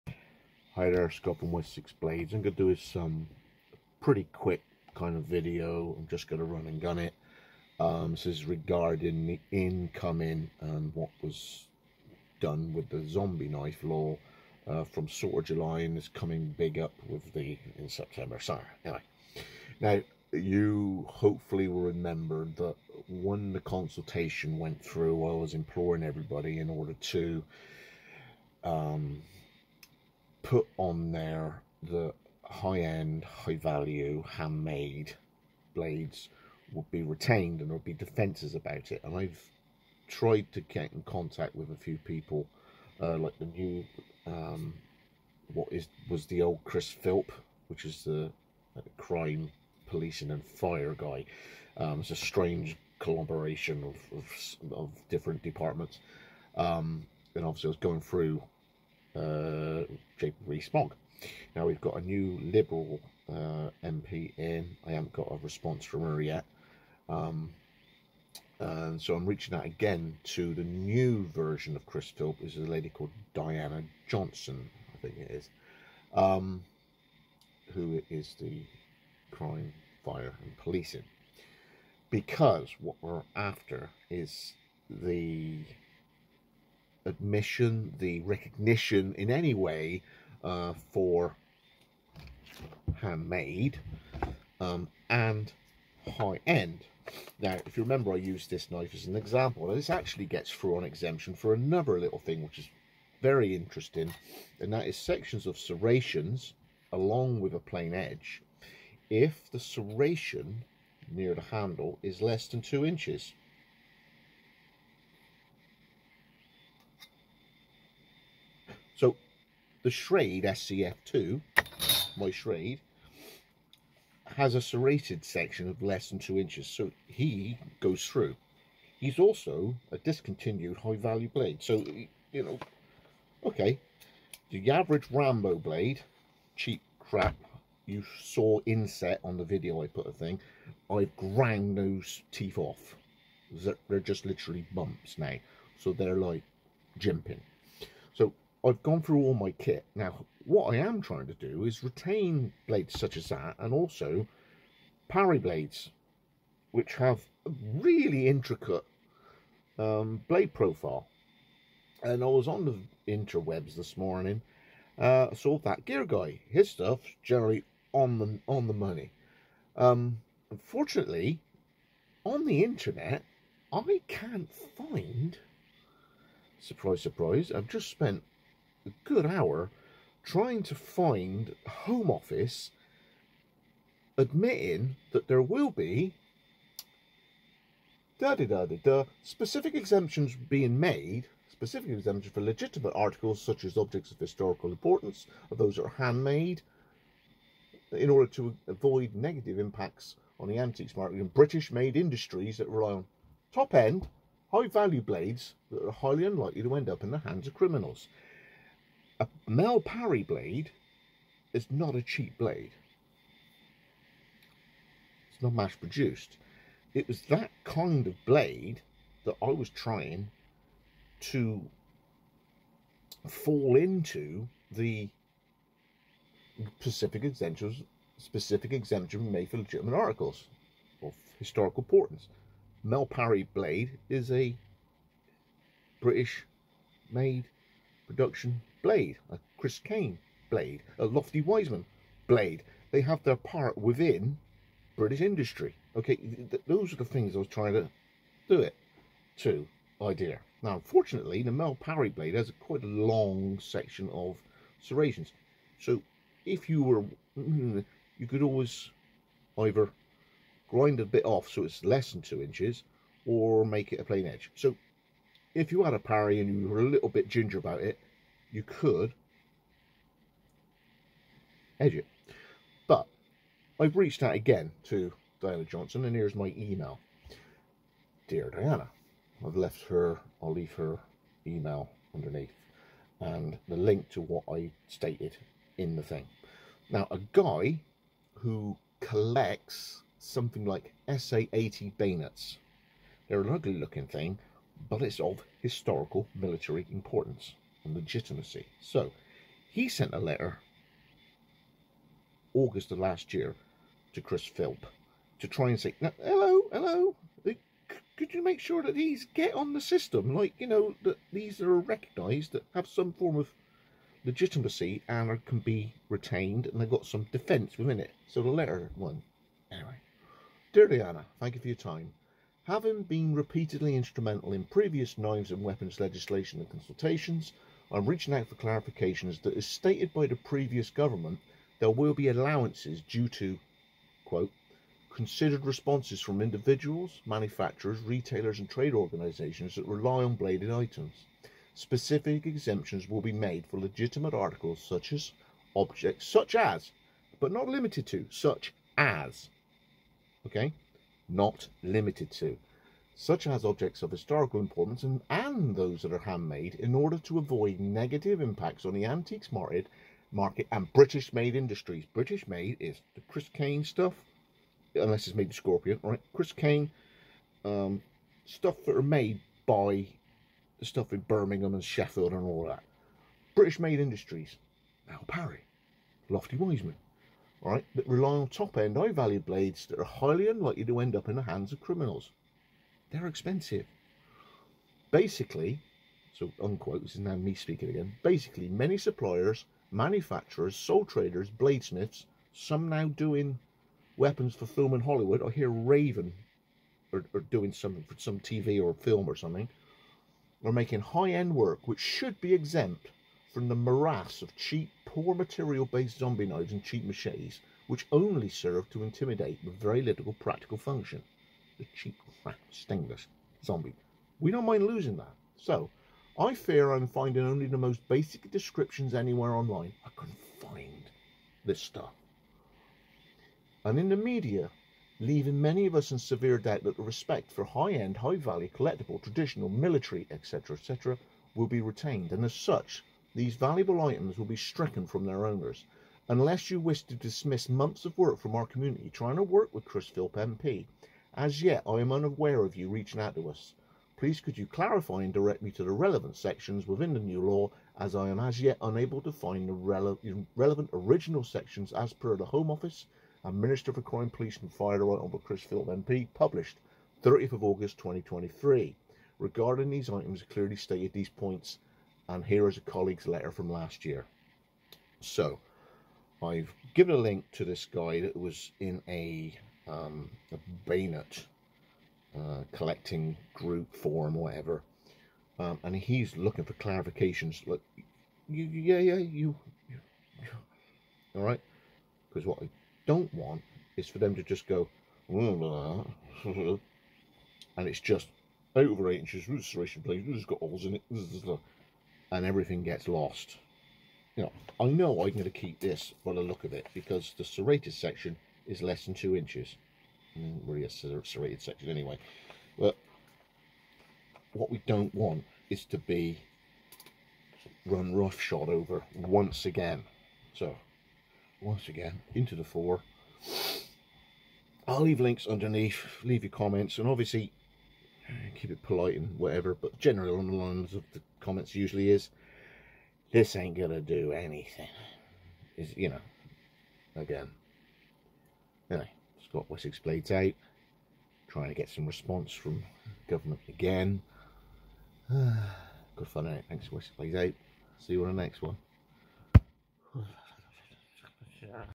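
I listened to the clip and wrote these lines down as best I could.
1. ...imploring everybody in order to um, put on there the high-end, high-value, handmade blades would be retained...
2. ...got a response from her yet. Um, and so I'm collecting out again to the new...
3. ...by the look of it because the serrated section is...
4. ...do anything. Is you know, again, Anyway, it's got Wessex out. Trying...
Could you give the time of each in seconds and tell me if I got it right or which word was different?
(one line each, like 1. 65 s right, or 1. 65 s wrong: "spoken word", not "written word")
1. 25 s right
2. 65 s wrong: "reaching", not "collecting"
3. 496 s right
4. 524 s right.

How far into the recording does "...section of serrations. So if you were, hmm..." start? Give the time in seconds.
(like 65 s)
253 s.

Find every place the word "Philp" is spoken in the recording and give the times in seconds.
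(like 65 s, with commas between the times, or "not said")
46 s, 72 s, 304 s, 440 s.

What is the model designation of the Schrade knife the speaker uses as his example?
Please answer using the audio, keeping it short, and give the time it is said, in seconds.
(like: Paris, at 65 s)
SCF2, at 120 s.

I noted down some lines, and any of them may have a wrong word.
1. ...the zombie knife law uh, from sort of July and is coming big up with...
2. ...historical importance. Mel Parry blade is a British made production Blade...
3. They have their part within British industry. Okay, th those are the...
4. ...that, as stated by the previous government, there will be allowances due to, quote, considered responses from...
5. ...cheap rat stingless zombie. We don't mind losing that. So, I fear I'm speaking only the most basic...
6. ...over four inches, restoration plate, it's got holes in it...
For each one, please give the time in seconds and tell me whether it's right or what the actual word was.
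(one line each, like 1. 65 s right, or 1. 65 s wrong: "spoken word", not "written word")
1. 12 s right
2. 231 s right
3. 242 s right
4. 329 s right
5. 411 s wrong: "finding", not "speaking"
6. 488 s wrong: "eight", not "four".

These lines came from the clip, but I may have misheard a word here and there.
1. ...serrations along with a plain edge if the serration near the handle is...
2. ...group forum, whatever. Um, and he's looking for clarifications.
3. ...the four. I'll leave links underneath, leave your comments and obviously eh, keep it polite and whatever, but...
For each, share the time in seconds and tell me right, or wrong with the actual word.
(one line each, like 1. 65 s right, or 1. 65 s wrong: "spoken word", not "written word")
1. 105 s right
2. 473 s right
3. 512 s right.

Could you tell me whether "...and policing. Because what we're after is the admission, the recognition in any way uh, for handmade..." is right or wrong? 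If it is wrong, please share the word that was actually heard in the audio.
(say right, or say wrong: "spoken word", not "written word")
right.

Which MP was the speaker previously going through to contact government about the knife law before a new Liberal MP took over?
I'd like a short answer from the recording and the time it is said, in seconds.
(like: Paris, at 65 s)
Jacob Rees-Mogg, at 60 s.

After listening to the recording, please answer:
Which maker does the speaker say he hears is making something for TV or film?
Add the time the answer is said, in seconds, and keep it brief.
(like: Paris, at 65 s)
Raven, at 395 s.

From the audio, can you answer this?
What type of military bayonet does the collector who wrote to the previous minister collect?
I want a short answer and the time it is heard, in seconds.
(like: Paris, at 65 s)
SA-80, at 291 s.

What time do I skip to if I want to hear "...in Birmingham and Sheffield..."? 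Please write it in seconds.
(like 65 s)
371 s.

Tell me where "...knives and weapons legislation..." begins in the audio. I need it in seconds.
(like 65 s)
325 s.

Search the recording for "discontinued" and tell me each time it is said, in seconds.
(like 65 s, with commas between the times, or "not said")
129 s.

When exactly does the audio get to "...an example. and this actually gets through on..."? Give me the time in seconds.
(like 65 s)
99 s.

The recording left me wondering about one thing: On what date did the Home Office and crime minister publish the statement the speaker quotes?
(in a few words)
30 August 2023.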